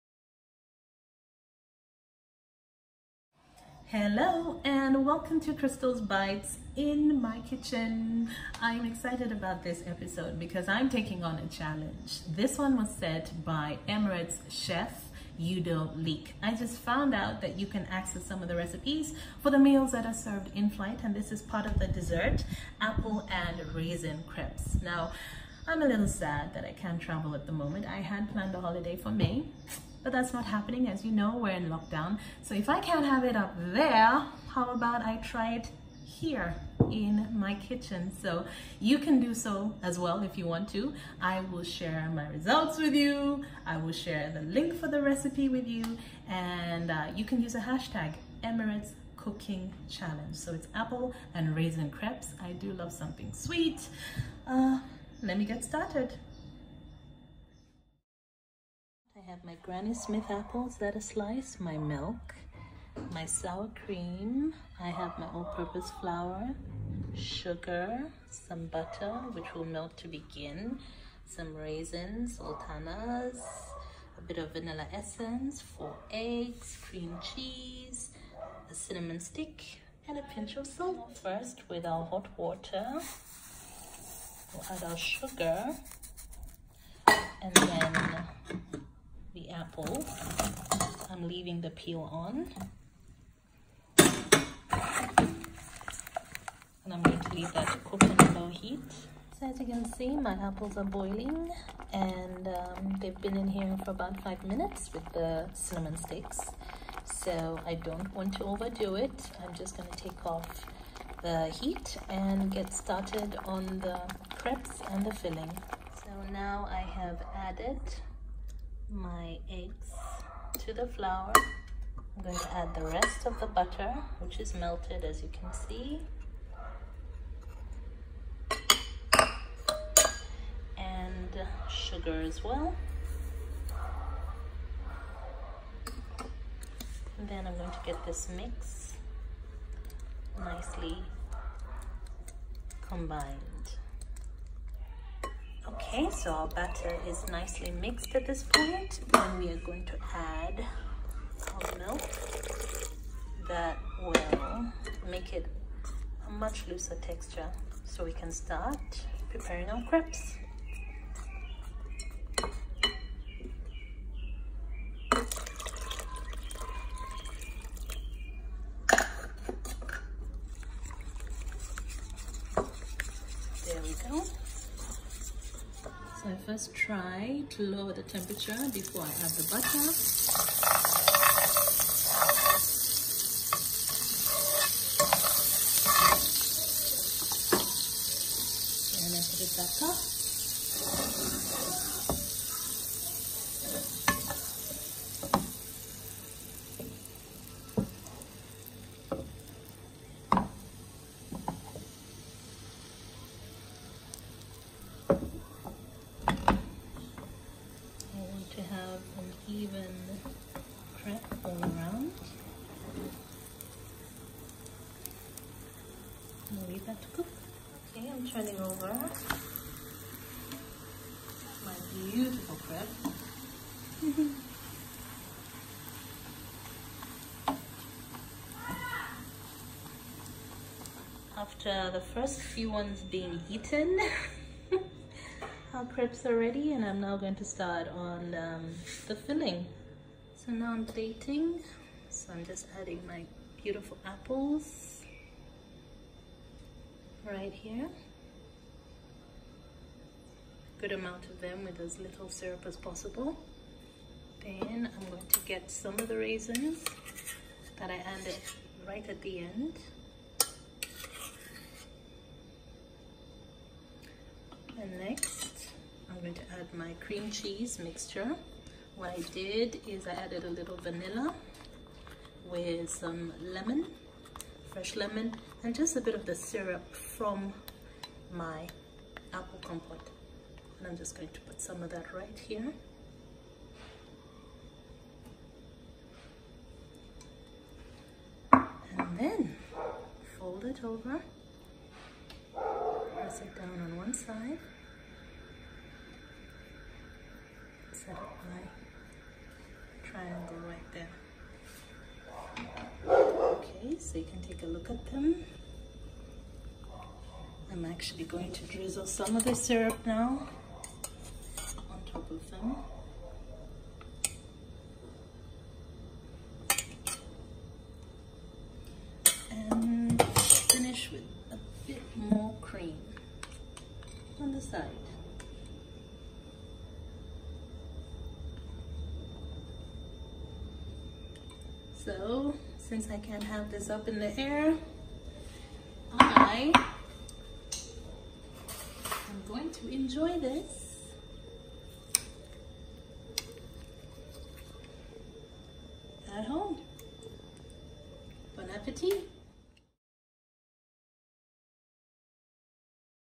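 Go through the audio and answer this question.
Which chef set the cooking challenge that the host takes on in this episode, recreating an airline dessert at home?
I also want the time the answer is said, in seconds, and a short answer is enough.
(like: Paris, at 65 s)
Udo Leick, at 15 s.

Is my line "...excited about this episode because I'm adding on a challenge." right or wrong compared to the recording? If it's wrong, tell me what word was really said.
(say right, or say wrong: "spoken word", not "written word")
wrong: "taking", not "adding".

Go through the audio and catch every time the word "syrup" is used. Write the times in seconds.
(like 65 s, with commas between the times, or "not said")
252 s, 276 s, 309 s.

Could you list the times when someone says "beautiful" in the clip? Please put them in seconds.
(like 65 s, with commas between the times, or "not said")
243 s.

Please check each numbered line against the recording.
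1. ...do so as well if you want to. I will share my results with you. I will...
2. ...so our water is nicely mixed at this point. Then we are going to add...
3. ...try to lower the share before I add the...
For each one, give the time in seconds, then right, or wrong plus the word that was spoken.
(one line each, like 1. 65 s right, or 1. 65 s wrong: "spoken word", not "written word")
1. 39 s right
2. 146 s wrong: "batter", not "water"
3. 176 s wrong: "temperature", not "share".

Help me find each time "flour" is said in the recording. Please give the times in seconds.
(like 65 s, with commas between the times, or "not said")
66 s, 120 s.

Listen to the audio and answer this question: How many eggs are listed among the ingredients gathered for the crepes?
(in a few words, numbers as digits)
4.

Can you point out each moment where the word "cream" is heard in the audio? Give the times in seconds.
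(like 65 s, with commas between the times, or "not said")
63 s, 76 s, 266 s, 322 s.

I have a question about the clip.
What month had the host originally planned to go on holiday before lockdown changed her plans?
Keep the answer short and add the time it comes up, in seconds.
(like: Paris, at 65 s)
May, at 29 s.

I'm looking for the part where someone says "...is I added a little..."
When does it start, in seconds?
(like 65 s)
269 s.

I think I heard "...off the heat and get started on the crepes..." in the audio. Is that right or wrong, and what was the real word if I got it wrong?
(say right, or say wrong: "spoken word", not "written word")
right.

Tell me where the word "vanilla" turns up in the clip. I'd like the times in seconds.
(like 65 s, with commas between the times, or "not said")
74 s, 270 s.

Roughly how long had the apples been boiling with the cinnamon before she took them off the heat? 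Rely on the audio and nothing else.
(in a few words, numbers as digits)
5 minutes.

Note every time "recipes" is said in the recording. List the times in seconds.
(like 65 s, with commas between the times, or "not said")
18 s, 45 s.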